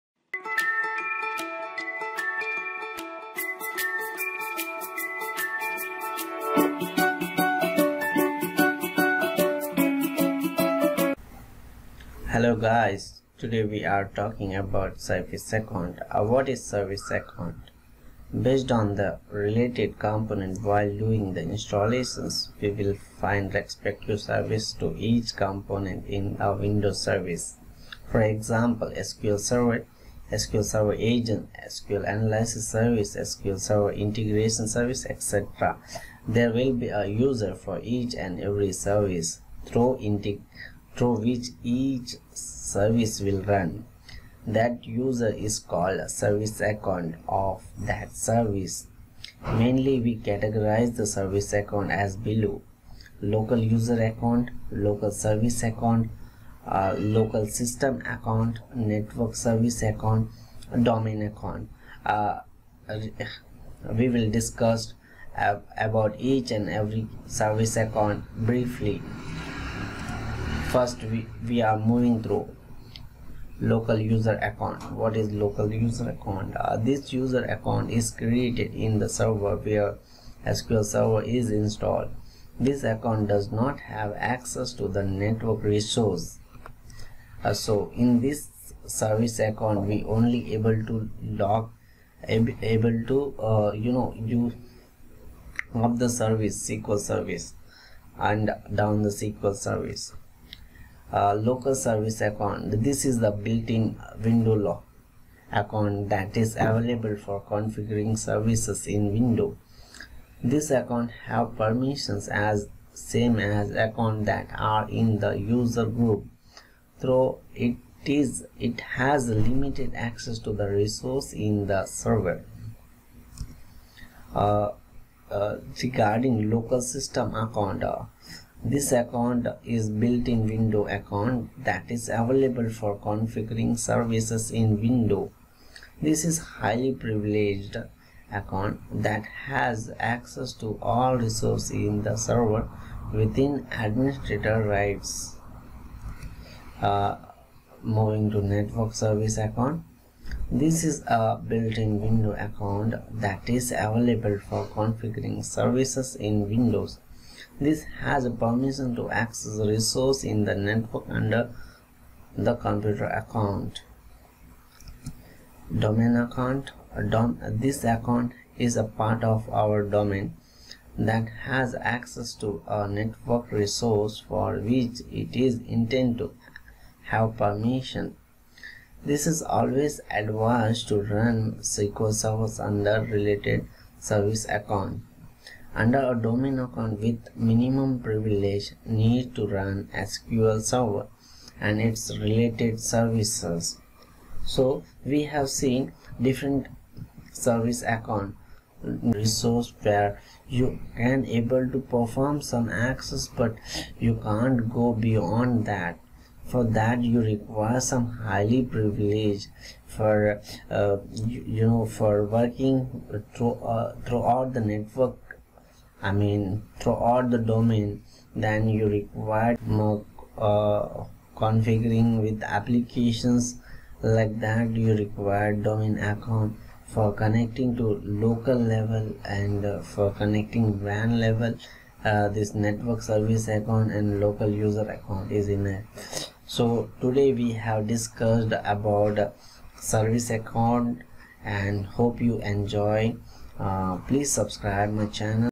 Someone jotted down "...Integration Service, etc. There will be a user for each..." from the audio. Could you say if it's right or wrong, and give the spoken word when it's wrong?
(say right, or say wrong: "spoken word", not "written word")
right.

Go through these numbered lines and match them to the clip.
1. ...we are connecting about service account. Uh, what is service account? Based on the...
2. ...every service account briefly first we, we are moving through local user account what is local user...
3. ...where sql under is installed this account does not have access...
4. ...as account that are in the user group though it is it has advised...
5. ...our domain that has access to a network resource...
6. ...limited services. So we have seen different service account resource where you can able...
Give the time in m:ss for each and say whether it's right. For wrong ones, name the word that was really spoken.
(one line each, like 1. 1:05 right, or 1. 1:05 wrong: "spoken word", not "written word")
1. 0:13 wrong: "talking", not "connecting"
2. 1:06 right
3. 1:19 wrong: "server", not "under"
4. 1:53 wrong: "limited", not "advised"
5. 2:49 right
6. 3:12 wrong: "related", not "limited".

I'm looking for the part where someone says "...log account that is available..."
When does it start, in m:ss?
1:44.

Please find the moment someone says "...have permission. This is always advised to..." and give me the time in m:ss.
2:57.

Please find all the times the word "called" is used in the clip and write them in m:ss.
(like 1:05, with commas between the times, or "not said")
0:45.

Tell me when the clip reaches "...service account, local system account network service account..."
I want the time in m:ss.
0:55.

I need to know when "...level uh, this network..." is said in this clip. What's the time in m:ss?
3:51.